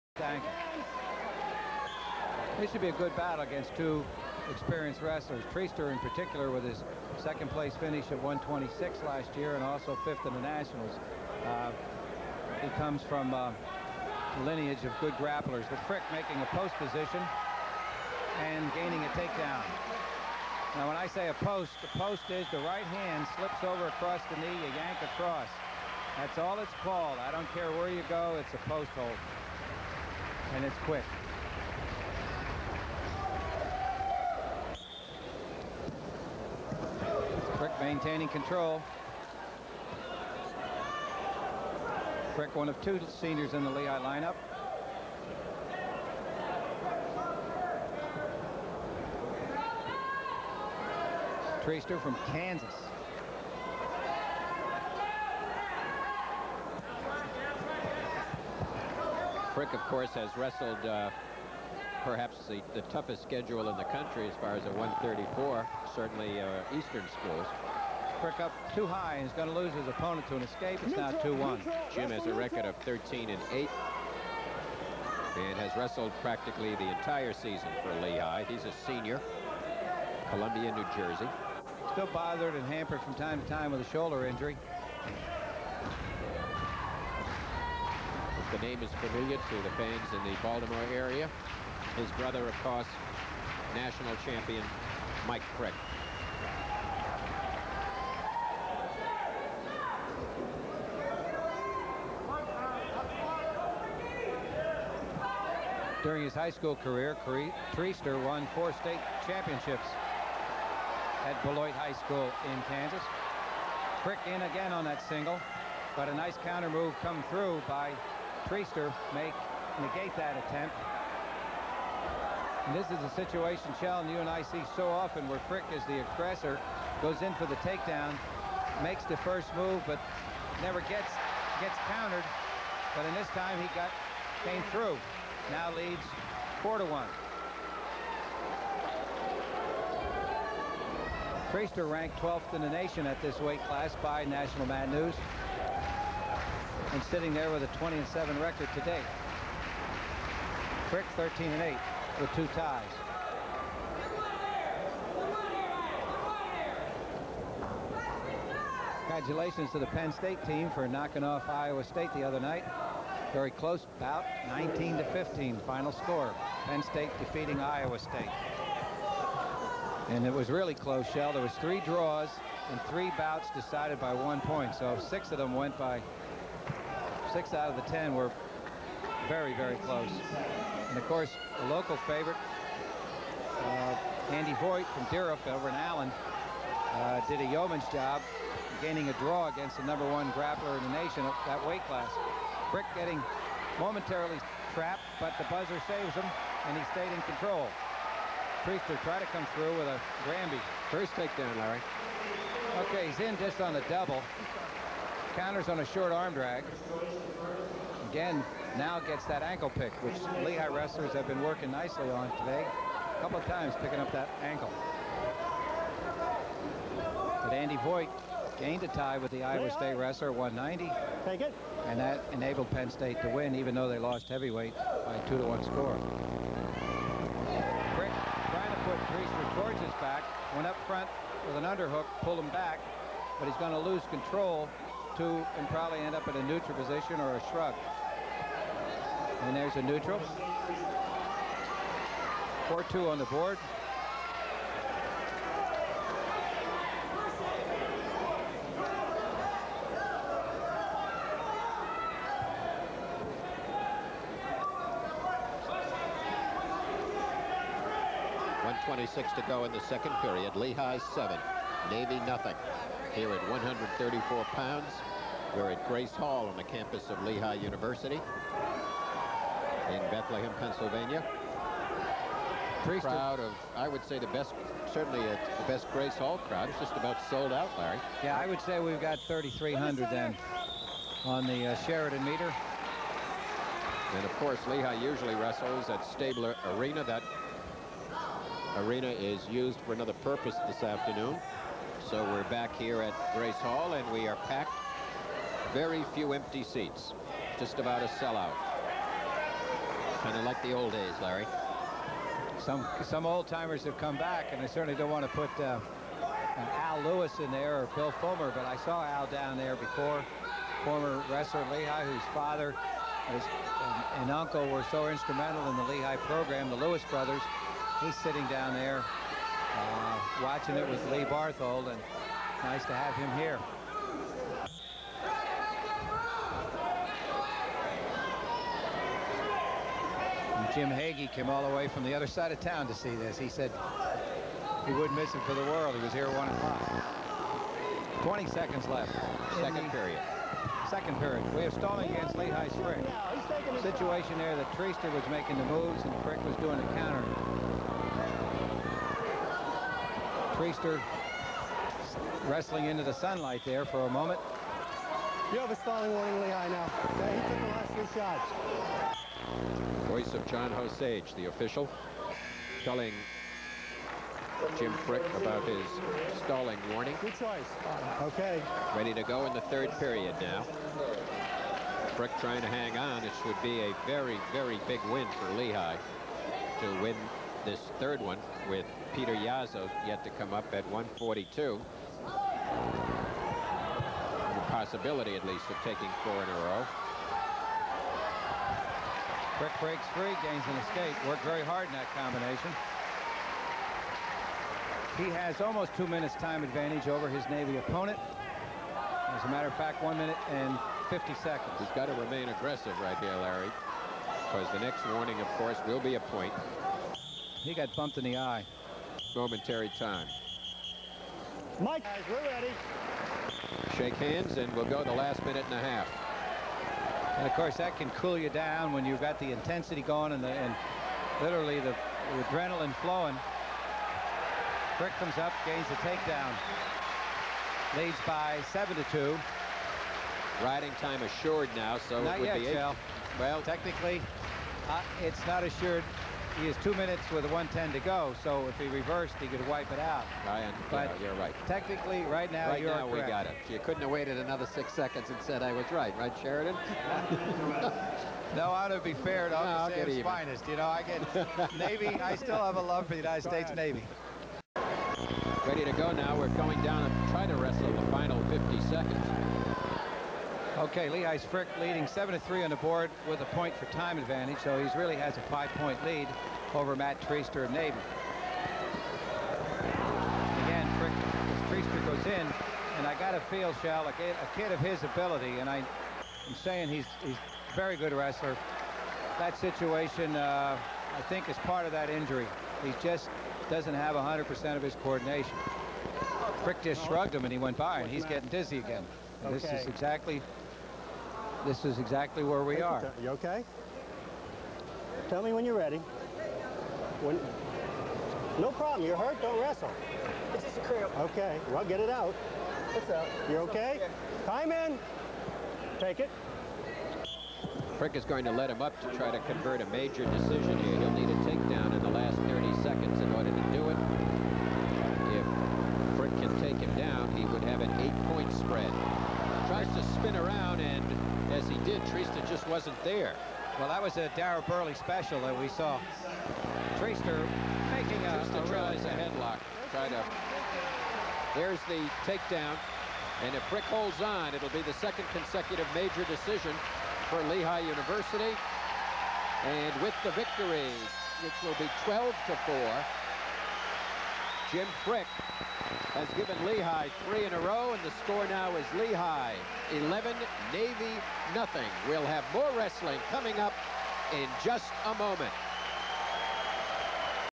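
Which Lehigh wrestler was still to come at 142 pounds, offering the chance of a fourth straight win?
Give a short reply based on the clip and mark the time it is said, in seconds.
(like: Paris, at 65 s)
Peter Yazzo, at 379 s.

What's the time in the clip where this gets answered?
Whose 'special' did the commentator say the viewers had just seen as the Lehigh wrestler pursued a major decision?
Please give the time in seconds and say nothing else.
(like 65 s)
524 s.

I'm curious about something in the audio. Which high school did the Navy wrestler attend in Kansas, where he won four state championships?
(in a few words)
Beloit High School.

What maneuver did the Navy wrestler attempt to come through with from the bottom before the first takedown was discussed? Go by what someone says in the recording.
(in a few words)
Granby.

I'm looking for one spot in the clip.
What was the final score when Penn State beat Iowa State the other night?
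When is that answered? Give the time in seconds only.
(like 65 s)
164 s.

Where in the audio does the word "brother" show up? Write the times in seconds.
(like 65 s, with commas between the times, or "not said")
92 s, 317 s.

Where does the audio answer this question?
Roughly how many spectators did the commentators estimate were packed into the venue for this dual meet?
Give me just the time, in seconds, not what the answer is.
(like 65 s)
279 s.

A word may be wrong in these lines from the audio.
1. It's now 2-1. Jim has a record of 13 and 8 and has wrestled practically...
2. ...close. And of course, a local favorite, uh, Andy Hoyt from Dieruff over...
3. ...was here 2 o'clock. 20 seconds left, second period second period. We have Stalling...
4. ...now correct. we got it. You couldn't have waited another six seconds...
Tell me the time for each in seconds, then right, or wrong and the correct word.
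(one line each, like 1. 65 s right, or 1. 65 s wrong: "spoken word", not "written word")
1. 70 s right
2. 179 s right
3. 336 s wrong: "1", not "2"
4. 442 s right.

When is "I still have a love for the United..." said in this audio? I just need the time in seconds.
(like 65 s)
452 s.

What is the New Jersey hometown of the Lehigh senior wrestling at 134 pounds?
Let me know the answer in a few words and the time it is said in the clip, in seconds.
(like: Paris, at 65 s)
Columbia, at 80 s.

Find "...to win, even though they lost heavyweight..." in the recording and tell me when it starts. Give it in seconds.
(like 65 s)
223 s.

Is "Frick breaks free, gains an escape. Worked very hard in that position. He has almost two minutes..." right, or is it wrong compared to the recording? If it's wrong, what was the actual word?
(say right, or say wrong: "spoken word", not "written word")
wrong: "combination", not "position".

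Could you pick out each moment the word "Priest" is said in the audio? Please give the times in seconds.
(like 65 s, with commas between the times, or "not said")
272 s.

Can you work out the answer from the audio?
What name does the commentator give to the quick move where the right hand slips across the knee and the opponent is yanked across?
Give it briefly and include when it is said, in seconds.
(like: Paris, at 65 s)
post hold, at 28 s.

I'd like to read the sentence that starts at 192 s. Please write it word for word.
Frick getting momentarily trapped, but the buzzer saves him, and he stayed in control.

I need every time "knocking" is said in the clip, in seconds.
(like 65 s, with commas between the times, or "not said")
160 s.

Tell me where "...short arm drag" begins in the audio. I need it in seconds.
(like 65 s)
205 s.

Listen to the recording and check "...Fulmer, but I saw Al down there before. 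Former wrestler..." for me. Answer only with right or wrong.
right.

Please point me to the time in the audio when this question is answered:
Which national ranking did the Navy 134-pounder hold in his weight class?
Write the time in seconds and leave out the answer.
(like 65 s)
142 s.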